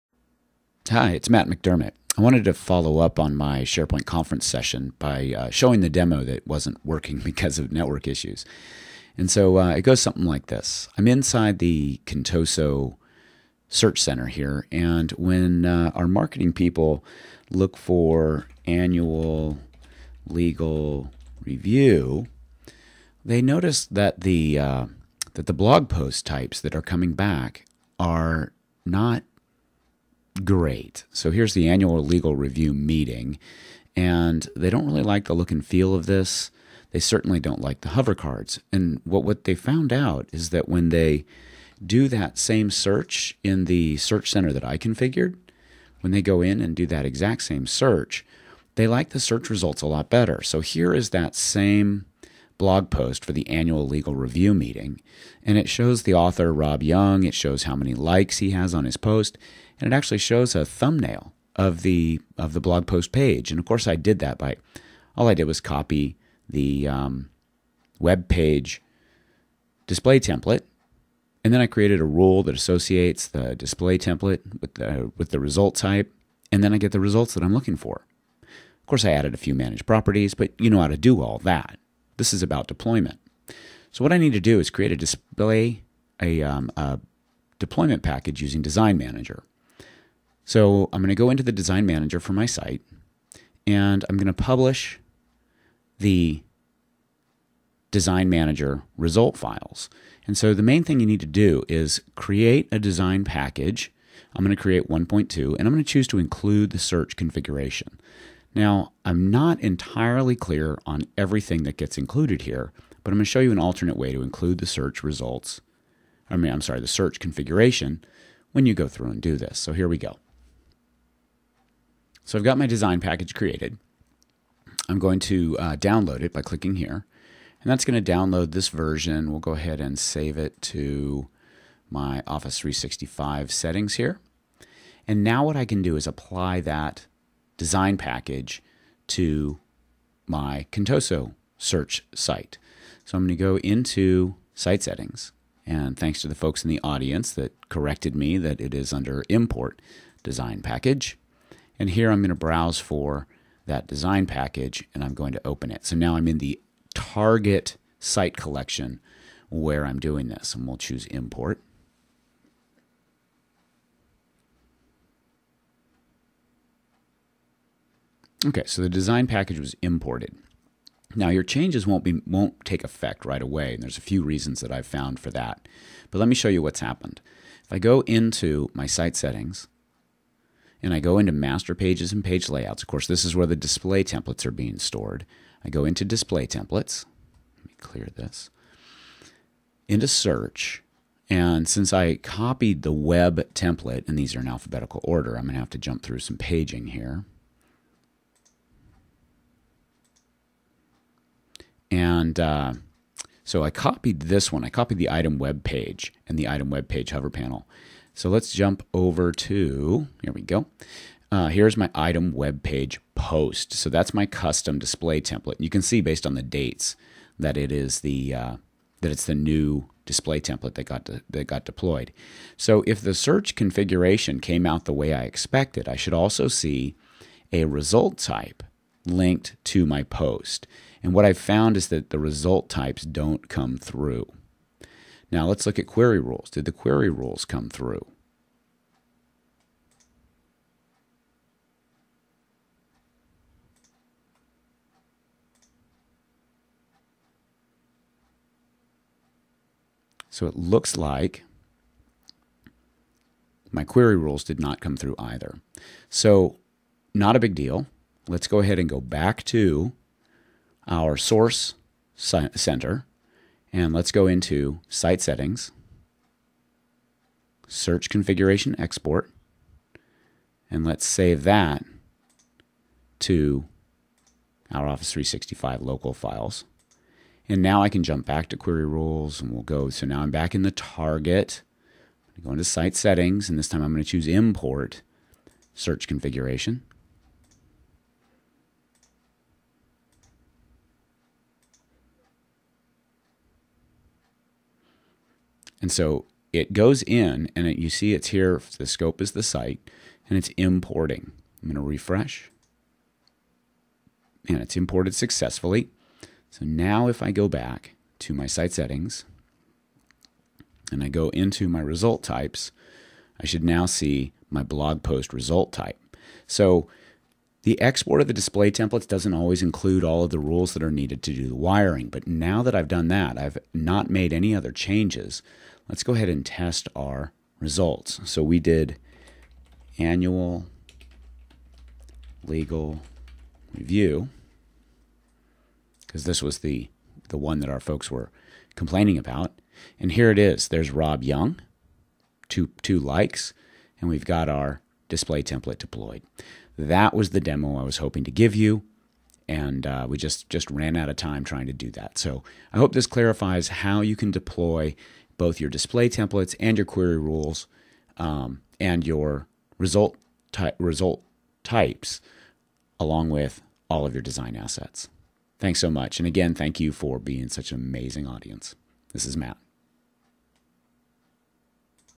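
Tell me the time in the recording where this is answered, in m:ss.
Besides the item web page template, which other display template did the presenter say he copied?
3:26.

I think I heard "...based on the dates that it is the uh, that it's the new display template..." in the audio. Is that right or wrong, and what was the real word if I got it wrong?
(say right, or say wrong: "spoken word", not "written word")
right.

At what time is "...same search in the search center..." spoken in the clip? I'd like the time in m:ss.
0:42.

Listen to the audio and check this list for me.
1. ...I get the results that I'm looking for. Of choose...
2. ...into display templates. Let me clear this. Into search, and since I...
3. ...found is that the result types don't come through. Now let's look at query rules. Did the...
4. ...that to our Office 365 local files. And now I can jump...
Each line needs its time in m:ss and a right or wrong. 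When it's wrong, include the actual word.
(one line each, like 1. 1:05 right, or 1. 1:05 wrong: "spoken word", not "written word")
1. 1:16 wrong: "course", not "choose"
2. 3:05 right
3. 3:51 right
4. 4:31 right.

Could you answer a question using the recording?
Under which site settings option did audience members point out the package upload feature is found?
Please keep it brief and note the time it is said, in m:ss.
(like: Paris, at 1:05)
import design package, at 2:29.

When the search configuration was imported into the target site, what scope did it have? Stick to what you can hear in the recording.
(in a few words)
the site.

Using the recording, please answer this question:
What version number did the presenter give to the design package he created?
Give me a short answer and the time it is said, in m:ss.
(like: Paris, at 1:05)
1.2, at 1:44.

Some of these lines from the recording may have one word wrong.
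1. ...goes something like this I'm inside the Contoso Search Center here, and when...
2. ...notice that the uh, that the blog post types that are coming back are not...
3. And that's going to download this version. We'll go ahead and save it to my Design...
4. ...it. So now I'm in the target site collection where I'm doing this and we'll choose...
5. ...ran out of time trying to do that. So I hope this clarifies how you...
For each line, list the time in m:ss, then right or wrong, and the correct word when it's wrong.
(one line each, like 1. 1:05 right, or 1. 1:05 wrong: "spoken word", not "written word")
1. 0:09 right
2. 0:23 right
3. 2:07 wrong: "Office", not "Design"
4. 2:35 right
5. 5:50 right.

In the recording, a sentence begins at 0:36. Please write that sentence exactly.
They certainly don't like the hover cards.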